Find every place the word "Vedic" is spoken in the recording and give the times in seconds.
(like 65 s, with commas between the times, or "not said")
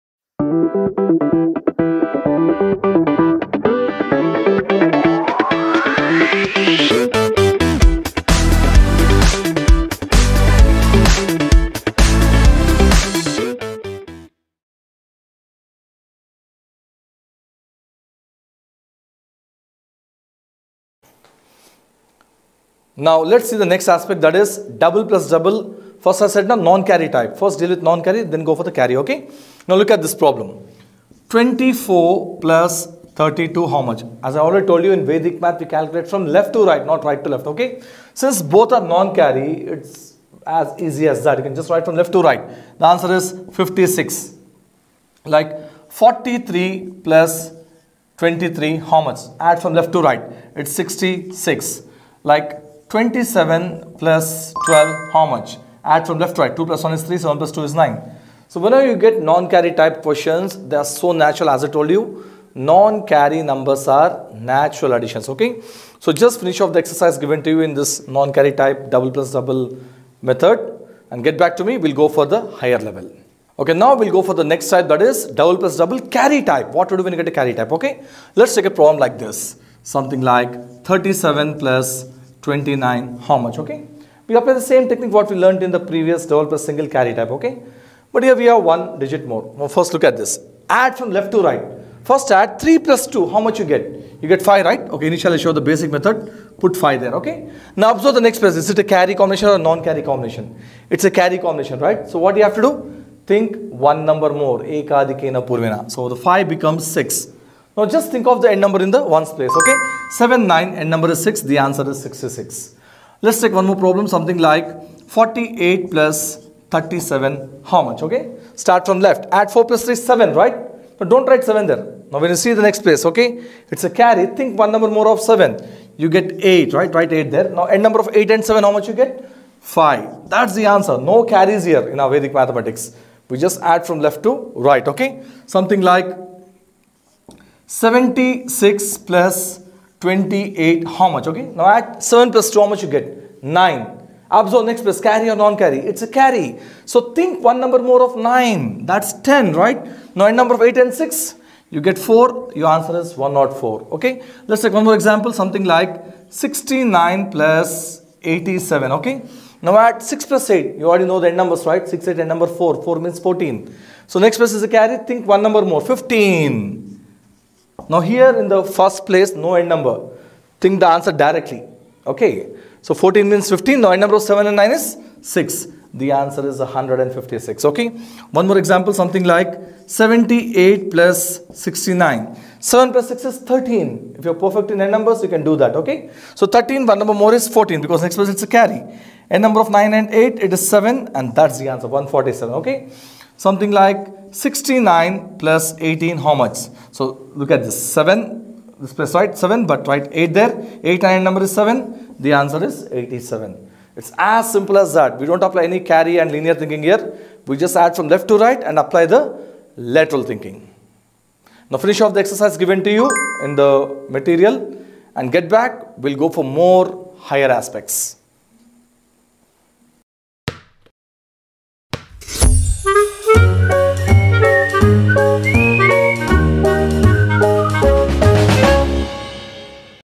35 s, 132 s.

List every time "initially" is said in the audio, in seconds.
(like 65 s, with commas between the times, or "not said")
95 s.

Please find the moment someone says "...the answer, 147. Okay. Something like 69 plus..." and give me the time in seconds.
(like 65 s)
191 s.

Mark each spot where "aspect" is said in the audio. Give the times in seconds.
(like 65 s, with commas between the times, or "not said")
23 s, 217 s.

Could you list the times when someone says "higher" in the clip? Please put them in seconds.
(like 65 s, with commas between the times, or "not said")
72 s, 217 s.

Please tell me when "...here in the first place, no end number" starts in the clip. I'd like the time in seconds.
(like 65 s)
167 s.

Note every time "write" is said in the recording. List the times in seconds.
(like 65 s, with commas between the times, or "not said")
41 s, 121 s, 126 s, 199 s.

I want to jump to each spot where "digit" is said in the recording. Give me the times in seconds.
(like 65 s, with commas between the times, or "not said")
88 s.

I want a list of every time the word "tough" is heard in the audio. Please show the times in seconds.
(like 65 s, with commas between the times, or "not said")
not said.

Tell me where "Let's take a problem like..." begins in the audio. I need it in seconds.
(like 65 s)
78 s.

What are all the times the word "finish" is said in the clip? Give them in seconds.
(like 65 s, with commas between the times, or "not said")
66 s, 211 s.